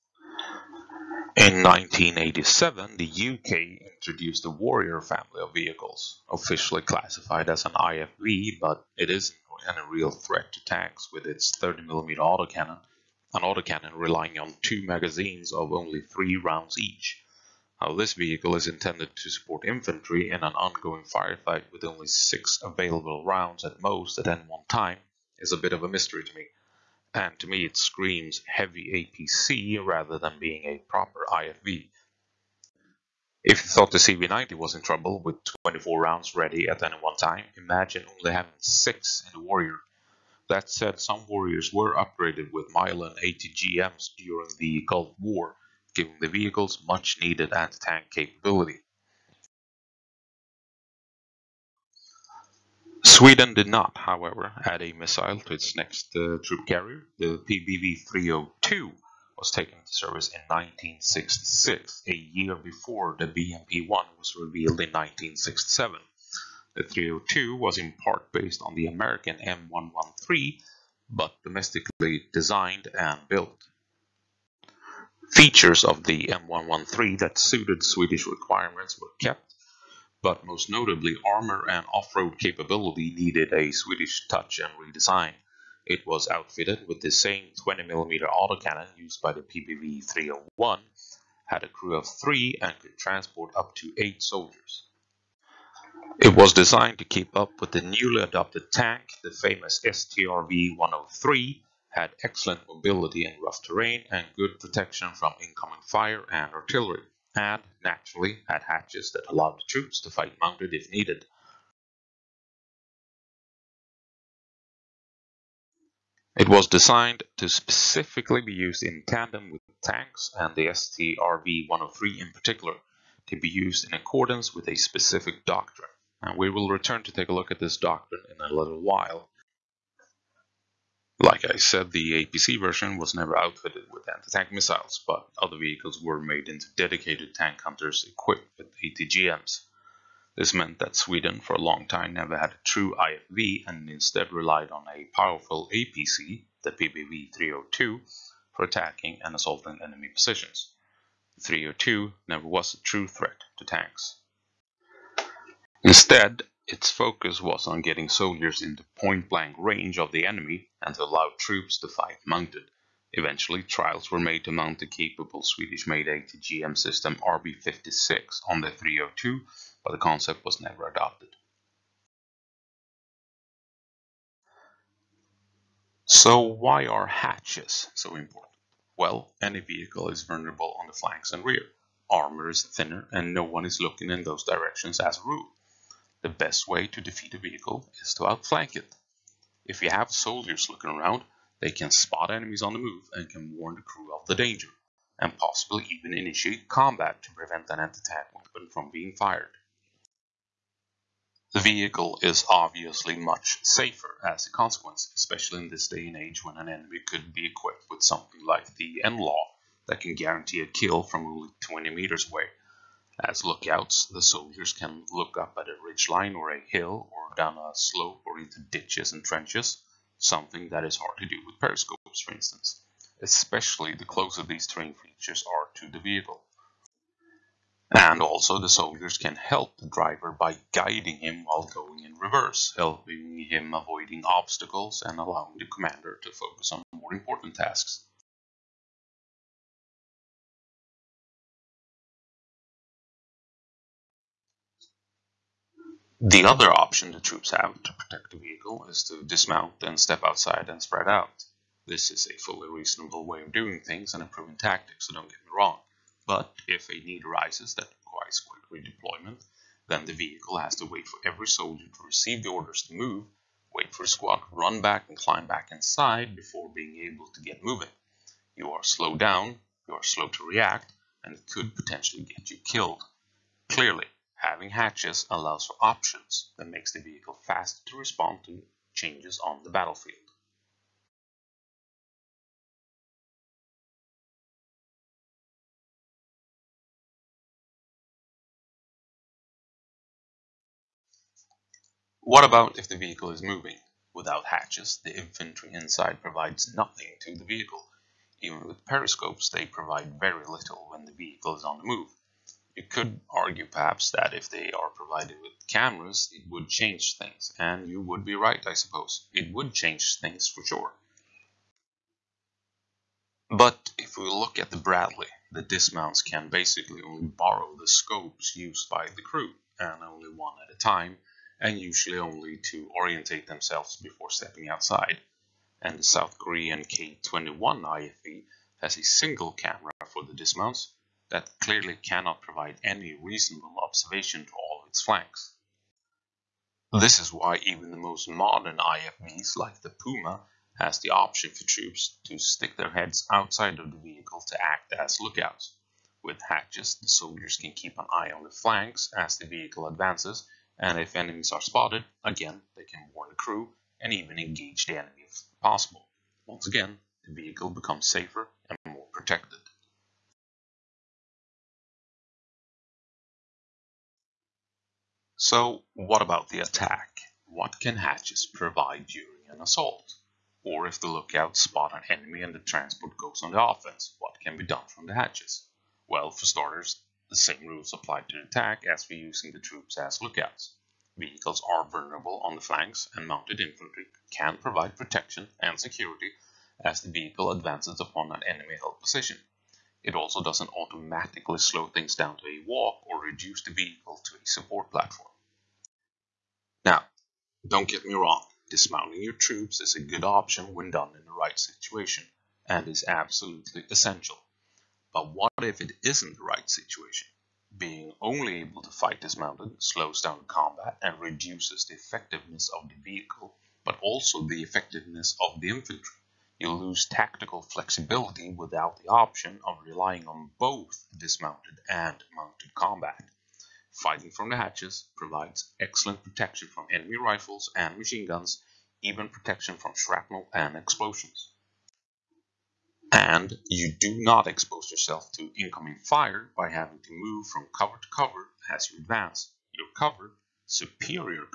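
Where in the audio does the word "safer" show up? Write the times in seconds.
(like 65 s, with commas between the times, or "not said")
203 s, 358 s.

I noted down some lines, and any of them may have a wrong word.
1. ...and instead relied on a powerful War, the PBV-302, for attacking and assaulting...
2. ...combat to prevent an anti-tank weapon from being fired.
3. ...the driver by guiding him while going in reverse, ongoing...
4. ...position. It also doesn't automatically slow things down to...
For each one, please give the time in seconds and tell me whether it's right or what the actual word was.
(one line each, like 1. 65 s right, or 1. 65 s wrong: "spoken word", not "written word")
1. 143 s wrong: "APC", not "War"
2. 196 s right
3. 229 s wrong: "helping", not "ongoing"
4. 389 s right.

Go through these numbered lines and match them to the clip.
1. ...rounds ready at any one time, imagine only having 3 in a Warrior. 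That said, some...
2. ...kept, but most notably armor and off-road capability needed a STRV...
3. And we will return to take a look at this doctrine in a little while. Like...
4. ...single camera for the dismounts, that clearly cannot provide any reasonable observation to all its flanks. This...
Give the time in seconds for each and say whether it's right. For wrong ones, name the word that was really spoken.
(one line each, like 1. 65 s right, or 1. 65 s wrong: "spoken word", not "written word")
1. 36 s wrong: "6", not "3"
2. 79 s wrong: "Swedish", not "STRV"
3. 126 s right
4. 329 s right.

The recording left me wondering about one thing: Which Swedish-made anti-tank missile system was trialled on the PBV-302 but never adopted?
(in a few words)
RB56.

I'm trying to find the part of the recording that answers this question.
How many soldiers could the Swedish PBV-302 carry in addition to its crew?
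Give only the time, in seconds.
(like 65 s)
93 s.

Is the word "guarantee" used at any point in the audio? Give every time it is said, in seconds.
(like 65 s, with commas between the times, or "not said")
210 s.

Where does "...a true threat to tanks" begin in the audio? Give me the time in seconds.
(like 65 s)
152 s.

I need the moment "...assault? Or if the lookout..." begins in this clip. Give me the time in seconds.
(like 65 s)
369 s.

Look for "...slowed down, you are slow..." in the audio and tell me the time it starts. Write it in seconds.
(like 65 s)
268 s.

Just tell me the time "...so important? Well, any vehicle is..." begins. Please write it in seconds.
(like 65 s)
177 s.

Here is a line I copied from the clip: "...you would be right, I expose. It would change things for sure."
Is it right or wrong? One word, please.
wrong.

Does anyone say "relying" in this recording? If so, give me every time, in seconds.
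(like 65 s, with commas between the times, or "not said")
13 s, 419 s.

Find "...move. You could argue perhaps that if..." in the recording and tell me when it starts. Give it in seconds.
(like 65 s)
301 s.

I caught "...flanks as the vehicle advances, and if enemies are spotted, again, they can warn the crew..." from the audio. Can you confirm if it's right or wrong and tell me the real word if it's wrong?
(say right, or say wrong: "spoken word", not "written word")
right.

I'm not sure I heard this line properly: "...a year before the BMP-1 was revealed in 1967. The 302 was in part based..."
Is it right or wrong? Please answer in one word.
right.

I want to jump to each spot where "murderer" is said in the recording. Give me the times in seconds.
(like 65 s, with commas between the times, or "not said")
not said.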